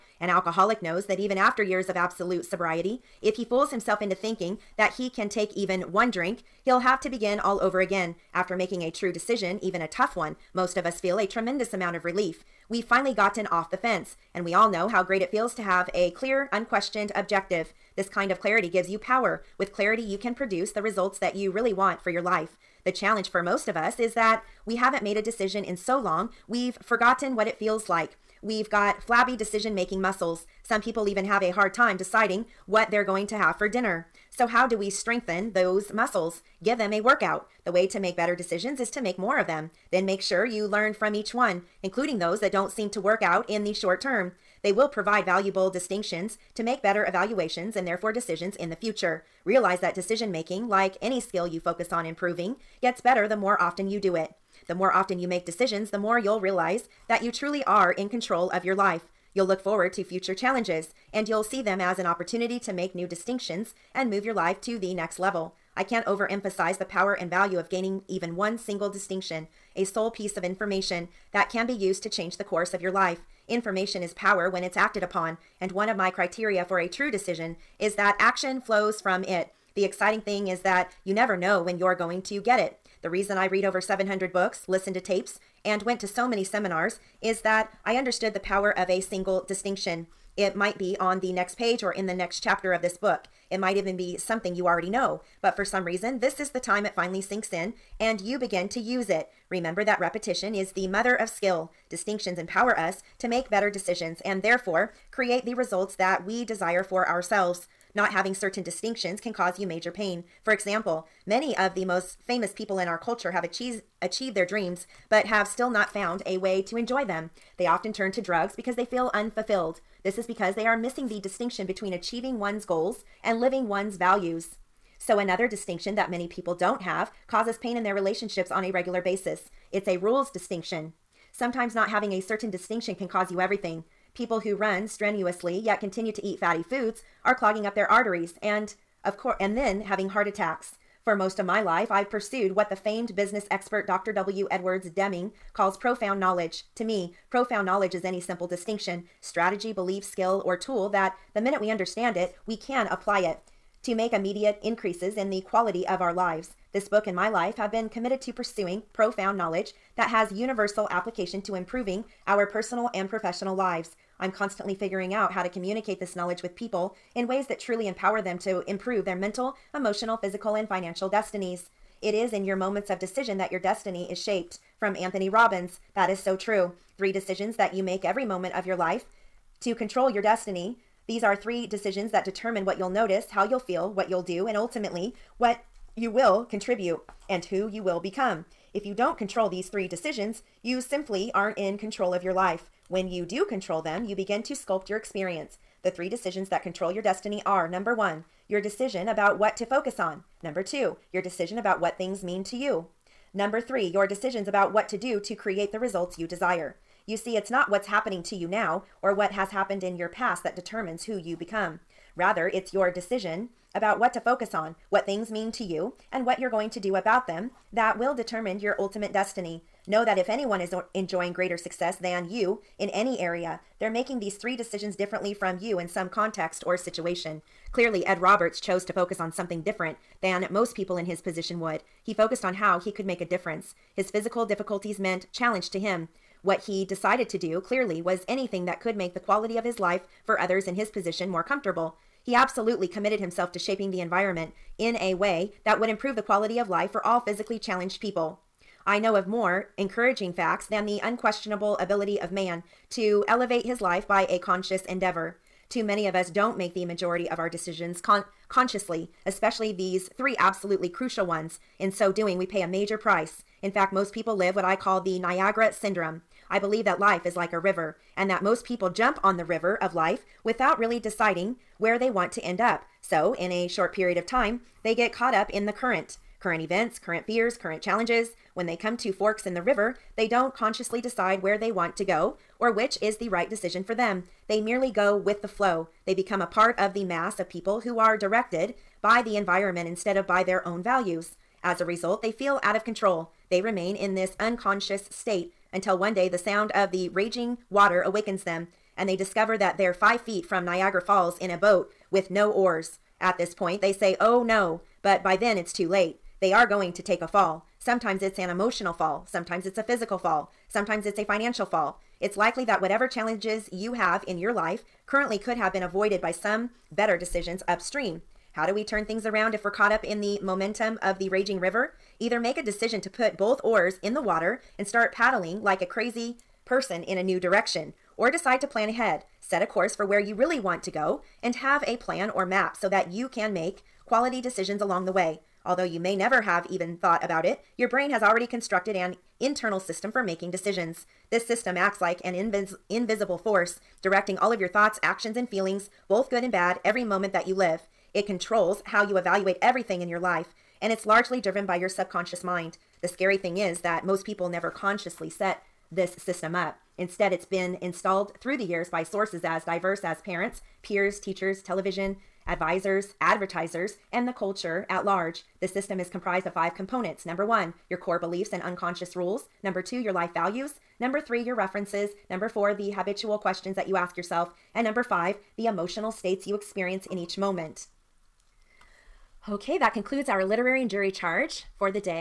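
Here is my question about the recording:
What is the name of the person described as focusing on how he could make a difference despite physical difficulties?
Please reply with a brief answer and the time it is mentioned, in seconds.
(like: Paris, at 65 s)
Ed Roberts, at 228 s.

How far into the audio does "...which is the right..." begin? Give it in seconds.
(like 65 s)
282 s.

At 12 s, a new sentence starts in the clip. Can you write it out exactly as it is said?
We've finally gotten off the fence, and we all know how great it feels to have a clear, unquestioned objective.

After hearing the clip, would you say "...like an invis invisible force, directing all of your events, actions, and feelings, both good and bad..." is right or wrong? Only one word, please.
wrong.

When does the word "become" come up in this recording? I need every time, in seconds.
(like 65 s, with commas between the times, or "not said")
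187 s, 211 s, 286 s.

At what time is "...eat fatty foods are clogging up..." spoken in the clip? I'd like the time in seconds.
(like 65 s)
136 s.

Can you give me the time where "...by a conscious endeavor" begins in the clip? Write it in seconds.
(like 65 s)
254 s.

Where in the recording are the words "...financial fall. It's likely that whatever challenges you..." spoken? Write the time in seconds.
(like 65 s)
311 s.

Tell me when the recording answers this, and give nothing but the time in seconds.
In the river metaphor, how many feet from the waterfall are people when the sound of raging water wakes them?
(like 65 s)
299 s.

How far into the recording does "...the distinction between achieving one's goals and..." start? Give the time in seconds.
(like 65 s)
121 s.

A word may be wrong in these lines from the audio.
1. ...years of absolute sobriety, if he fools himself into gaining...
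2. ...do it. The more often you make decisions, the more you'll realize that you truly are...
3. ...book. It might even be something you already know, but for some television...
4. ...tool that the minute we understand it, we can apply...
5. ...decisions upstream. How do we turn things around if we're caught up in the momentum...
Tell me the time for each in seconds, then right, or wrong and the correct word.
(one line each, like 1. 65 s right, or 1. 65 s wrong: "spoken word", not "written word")
1. 1 s wrong: "thinking", not "gaining"
2. 53 s right
3. 92 s wrong: "reason", not "television"
4. 150 s right
5. 317 s right.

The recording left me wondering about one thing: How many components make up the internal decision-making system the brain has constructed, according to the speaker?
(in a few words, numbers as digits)
5.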